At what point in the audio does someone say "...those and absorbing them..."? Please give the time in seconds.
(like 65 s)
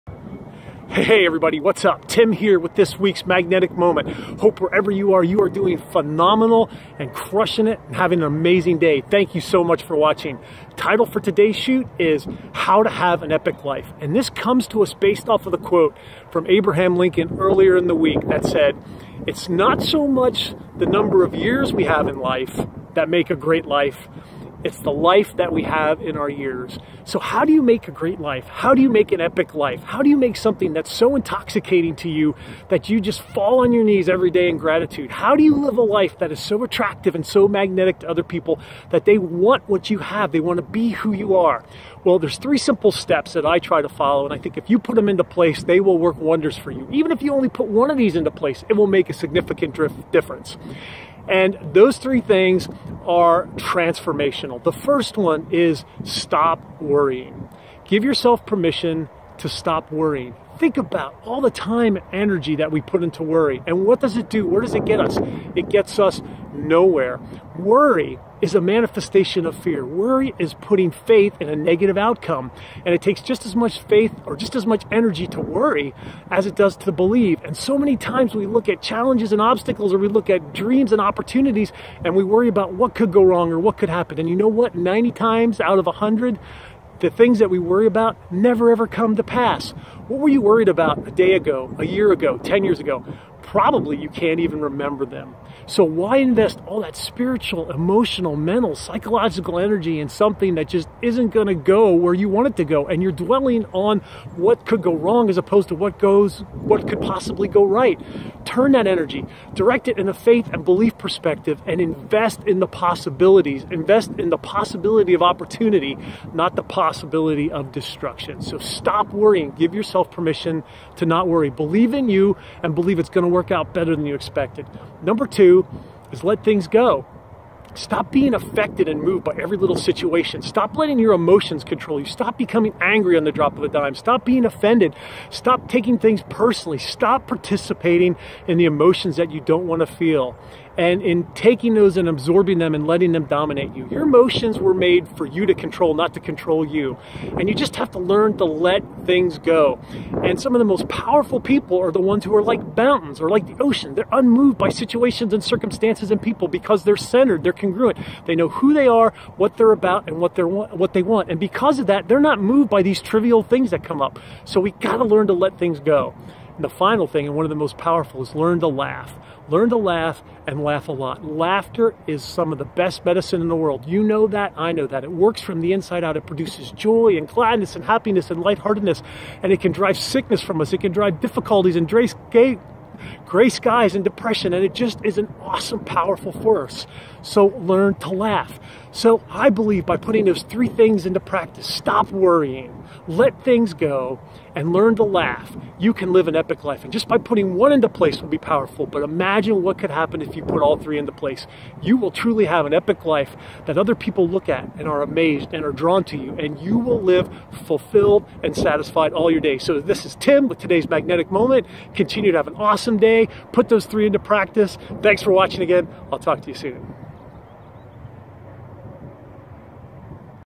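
141 s.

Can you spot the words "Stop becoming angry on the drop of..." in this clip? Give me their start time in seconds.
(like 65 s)
132 s.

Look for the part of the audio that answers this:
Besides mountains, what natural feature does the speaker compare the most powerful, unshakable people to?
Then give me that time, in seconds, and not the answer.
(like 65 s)
153 s.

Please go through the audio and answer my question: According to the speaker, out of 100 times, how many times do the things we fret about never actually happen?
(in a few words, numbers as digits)
90.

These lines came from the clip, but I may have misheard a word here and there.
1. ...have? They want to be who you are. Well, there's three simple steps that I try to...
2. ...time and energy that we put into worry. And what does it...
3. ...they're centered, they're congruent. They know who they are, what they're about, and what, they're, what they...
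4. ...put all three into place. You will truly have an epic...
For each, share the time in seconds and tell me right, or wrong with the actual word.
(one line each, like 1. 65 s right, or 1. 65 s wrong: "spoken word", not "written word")
1. 39 s right
2. 61 s right
3. 156 s right
4. 200 s right.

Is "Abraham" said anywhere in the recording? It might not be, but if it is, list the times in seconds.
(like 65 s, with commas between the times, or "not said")
16 s.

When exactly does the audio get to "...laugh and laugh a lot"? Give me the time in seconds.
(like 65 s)
169 s.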